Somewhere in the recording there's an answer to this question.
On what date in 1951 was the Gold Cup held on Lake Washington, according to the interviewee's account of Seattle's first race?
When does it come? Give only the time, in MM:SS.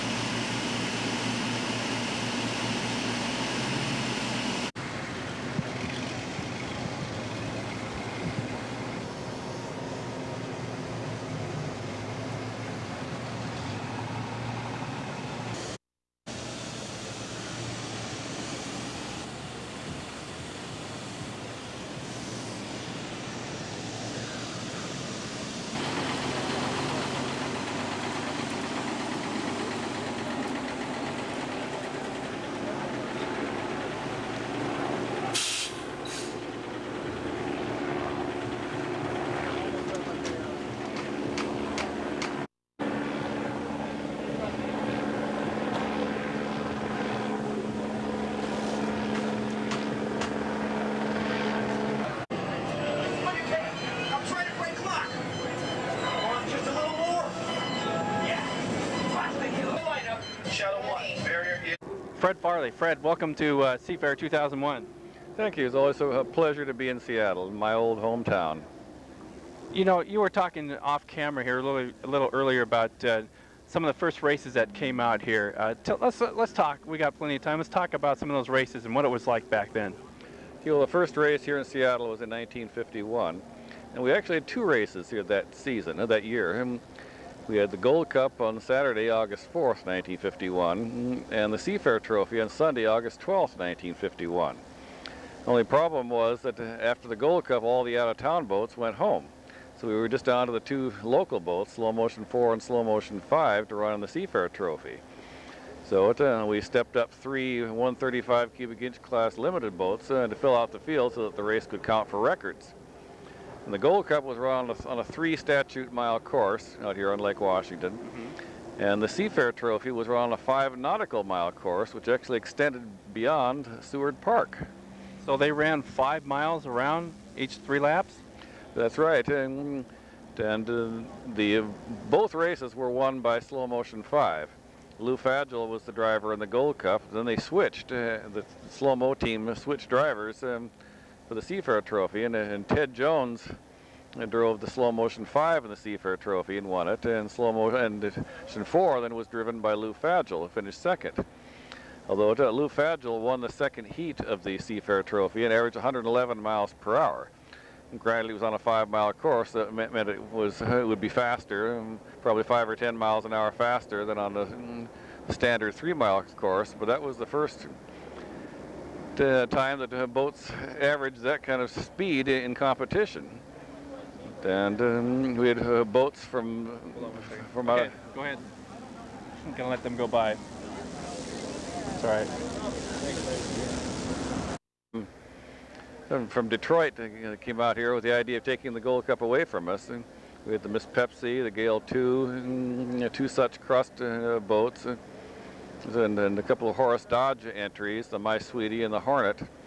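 01:29.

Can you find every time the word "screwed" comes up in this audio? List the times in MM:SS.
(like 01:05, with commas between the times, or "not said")
not said.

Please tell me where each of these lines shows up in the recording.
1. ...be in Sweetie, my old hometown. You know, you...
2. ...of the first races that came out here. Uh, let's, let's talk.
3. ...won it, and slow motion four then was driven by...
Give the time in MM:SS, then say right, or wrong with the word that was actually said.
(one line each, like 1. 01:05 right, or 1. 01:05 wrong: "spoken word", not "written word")
1. 01:06 wrong: "Seattle", not "Sweetie"
2. 01:13 right
3. 02:26 right.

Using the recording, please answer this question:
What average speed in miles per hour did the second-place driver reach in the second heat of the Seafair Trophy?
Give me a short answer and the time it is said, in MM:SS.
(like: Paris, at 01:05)
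111, at 02:35.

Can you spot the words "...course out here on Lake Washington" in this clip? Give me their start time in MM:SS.
01:56.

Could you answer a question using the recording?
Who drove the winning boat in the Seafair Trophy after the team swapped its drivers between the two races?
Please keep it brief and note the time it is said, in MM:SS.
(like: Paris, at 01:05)
Ted Jones, at 02:22.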